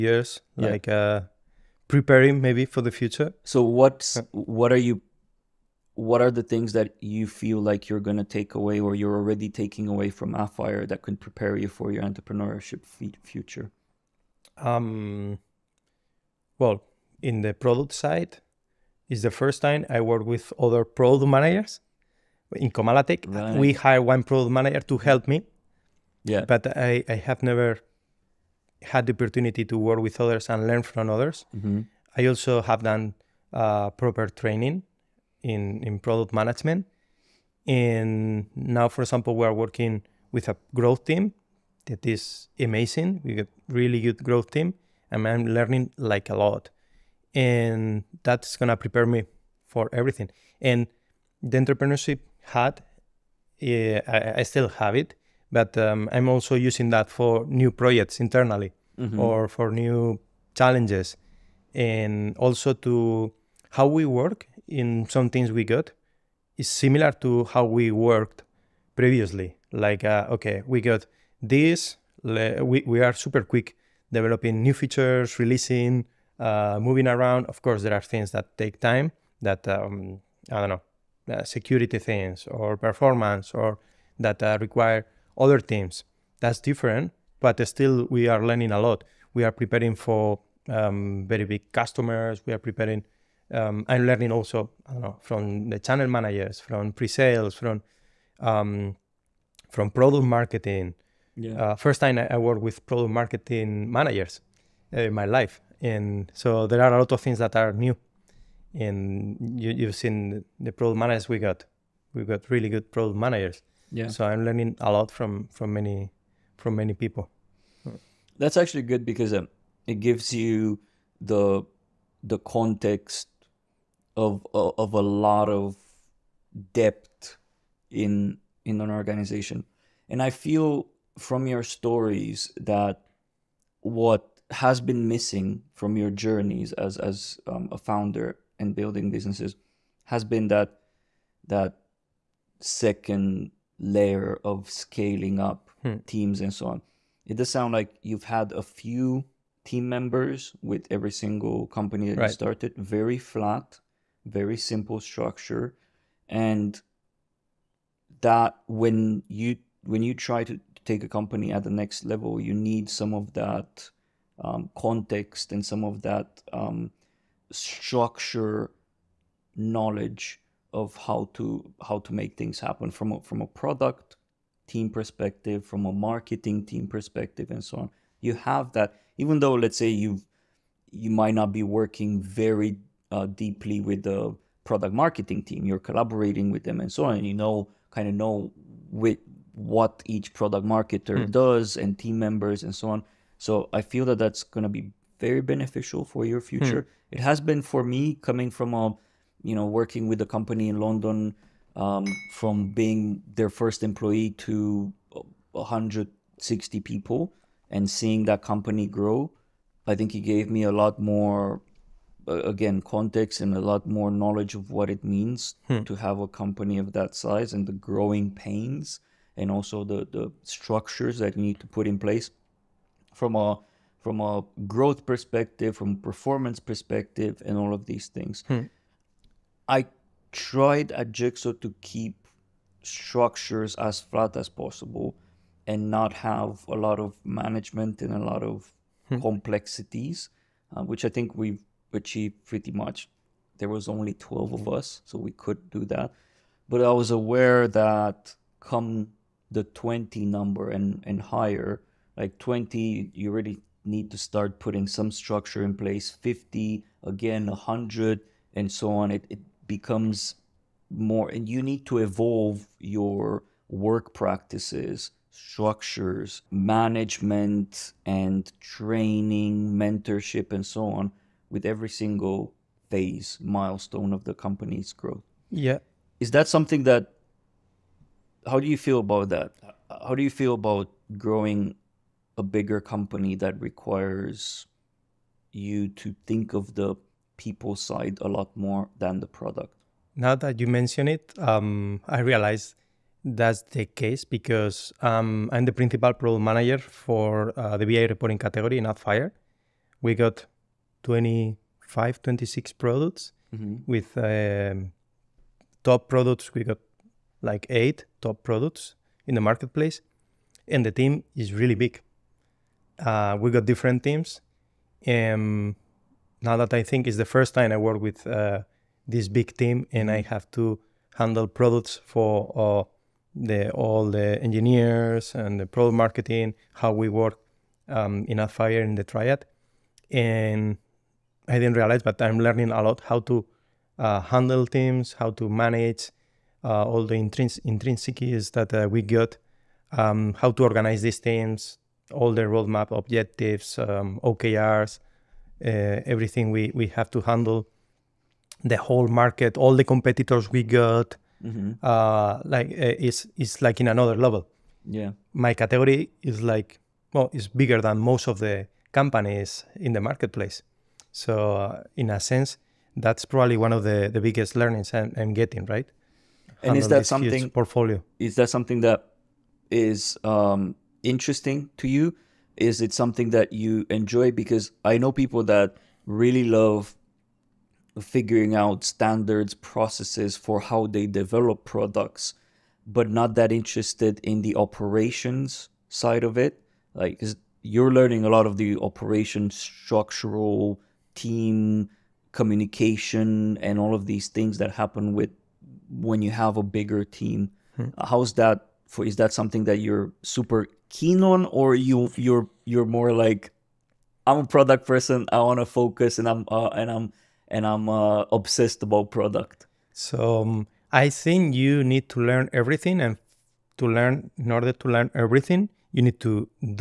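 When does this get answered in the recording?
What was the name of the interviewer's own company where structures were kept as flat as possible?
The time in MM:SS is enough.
03:51.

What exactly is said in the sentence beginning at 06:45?
I want to focus, and I'm uh, and I'm and I'm uh, obsessed about product.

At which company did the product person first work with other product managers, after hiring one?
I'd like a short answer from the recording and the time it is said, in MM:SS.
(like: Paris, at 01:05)
Comalatech, at 00:22.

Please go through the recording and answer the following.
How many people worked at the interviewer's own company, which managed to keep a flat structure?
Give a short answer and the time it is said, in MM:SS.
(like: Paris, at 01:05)
12, at 04:04.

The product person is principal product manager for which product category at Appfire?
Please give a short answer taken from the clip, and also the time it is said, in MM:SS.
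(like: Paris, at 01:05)
BI reporting, at 04:57.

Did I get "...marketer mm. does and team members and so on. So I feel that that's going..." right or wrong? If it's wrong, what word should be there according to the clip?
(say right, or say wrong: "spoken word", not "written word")
right.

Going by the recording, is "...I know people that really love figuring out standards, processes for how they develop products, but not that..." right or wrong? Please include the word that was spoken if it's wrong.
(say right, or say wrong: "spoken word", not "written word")
right.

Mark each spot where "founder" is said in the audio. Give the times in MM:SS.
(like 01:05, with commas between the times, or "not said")
02:17.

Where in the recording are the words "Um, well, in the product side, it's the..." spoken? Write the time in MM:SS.
00:14.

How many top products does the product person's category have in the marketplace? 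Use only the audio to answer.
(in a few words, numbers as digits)
8.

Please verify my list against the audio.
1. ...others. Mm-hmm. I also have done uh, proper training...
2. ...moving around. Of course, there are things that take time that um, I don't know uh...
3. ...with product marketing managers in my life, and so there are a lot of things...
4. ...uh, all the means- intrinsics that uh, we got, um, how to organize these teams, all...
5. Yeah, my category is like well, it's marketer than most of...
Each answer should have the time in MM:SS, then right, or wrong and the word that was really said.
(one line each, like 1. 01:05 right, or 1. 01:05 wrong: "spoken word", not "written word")
1. 00:31 right
2. 01:16 right
3. 01:42 right
4. 05:36 wrong: "intrins", not "means"
5. 05:54 wrong: "bigger", not "marketer".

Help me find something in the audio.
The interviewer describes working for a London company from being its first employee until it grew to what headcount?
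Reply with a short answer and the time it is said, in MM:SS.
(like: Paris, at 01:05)
160, at 03:25.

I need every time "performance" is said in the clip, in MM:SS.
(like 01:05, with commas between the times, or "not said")
01:22, 03:45.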